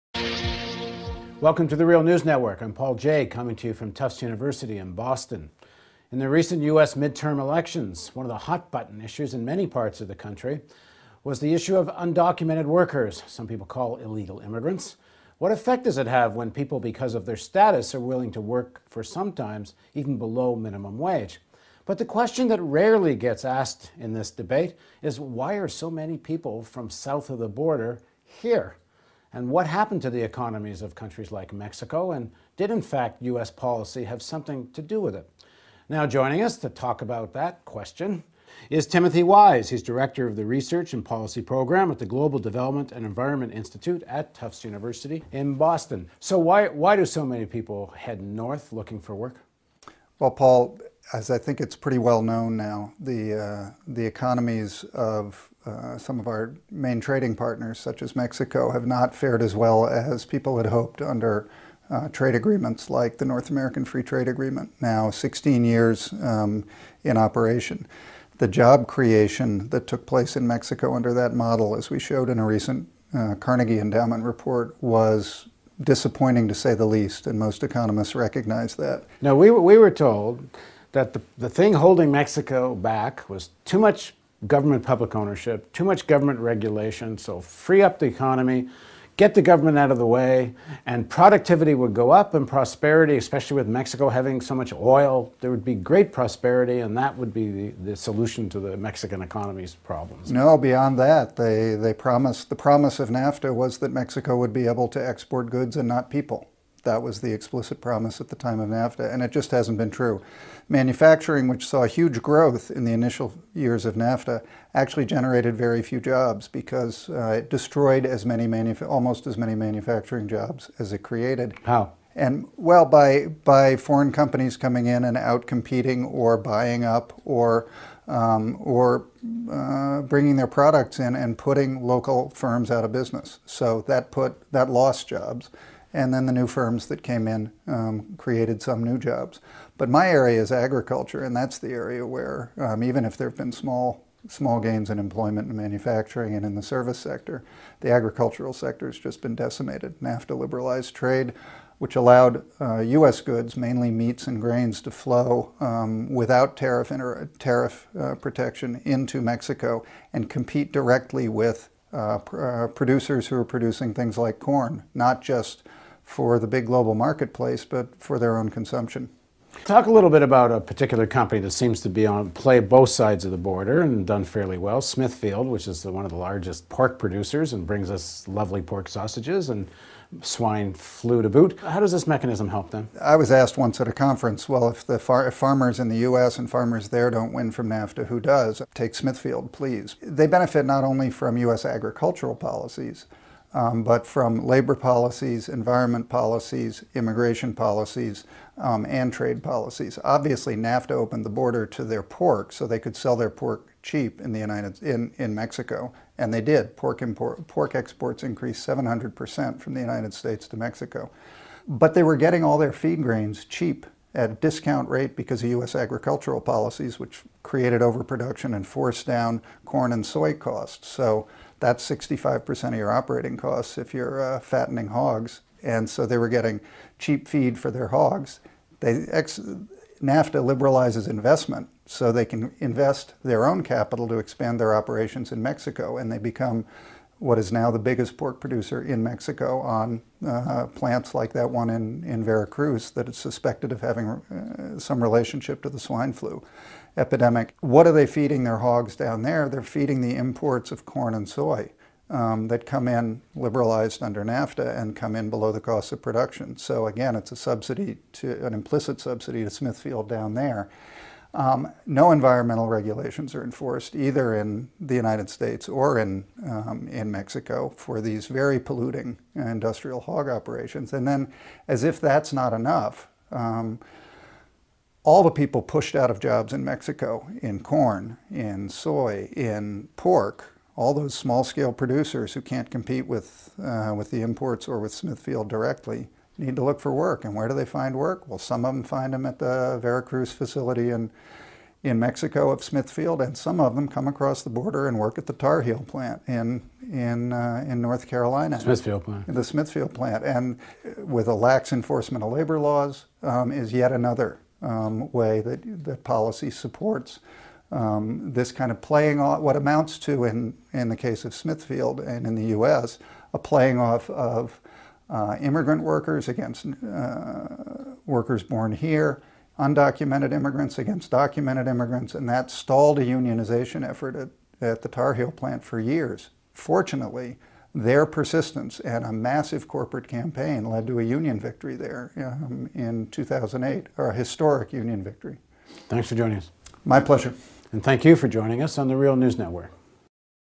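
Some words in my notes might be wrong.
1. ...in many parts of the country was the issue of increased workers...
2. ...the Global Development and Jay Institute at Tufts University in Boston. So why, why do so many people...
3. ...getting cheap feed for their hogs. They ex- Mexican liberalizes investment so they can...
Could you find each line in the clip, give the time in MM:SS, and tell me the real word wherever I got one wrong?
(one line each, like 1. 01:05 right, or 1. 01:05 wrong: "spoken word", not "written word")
1. 00:09 wrong: "undocumented", not "increased"
2. 00:41 wrong: "Environment", not "Jay"
3. 03:46 wrong: "NAFTA", not "Mexican".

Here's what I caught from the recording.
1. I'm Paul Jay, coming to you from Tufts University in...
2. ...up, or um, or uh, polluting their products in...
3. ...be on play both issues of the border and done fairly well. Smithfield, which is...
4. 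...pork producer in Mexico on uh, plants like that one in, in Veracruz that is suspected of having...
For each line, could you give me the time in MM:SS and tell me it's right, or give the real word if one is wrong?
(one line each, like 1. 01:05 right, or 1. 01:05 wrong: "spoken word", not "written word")
1. 00:02 right
2. 02:06 wrong: "bringing", not "polluting"
3. 02:51 wrong: "sides", not "issues"
4. 03:58 right.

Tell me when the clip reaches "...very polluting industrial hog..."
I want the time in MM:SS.
04:28.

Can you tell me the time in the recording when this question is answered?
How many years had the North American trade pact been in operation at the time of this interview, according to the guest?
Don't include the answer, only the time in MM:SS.
01:05.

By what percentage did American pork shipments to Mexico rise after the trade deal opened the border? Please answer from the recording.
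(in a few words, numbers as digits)
700 percent.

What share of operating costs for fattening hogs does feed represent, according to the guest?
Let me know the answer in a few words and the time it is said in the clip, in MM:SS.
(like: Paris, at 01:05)
65%, at 03:41.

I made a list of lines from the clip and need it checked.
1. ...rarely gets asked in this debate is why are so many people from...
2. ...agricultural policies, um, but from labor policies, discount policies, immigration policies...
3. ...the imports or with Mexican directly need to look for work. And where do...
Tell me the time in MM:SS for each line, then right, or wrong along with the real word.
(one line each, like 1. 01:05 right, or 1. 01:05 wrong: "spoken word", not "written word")
1. 00:22 right
2. 03:11 wrong: "environment", not "discount"
3. 04:44 wrong: "Smithfield", not "Mexican".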